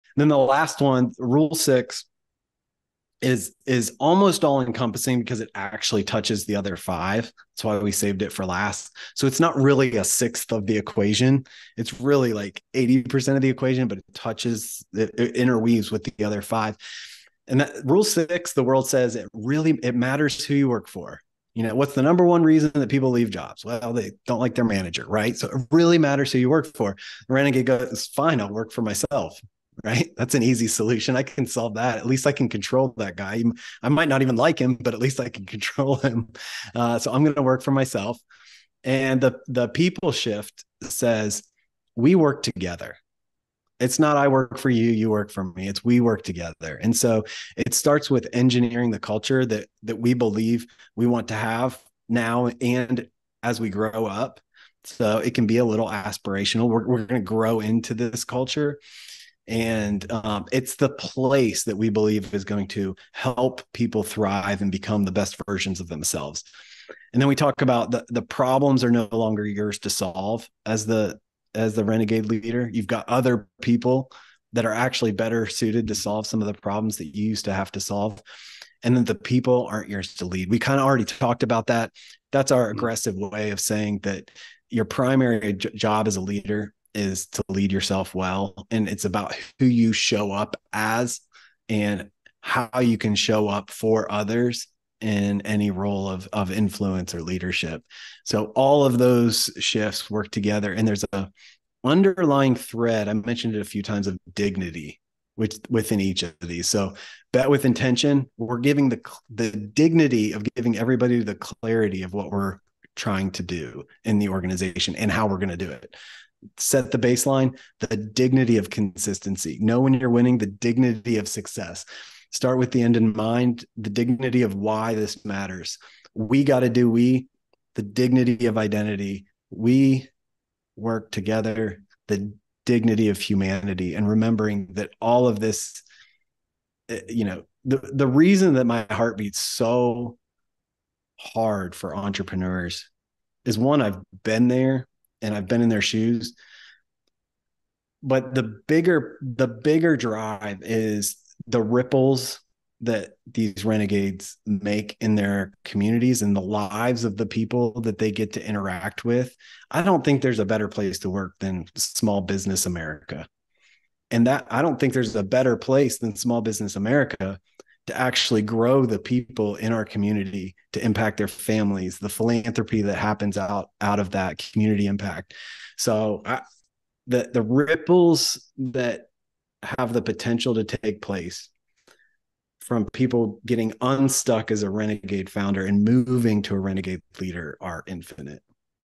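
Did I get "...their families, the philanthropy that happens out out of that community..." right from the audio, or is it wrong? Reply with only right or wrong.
right.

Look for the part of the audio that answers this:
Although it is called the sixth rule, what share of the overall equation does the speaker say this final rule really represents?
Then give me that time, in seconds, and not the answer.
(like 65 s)
12 s.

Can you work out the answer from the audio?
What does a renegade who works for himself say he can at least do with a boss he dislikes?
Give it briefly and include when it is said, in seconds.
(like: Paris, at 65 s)
control him, at 35 s.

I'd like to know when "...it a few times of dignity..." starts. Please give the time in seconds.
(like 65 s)
103 s.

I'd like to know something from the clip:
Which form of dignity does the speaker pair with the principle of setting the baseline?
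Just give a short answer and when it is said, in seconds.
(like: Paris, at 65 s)
consistency, at 117 s.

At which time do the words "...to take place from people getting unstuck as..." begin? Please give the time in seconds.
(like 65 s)
180 s.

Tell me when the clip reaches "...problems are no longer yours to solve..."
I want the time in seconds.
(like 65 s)
68 s.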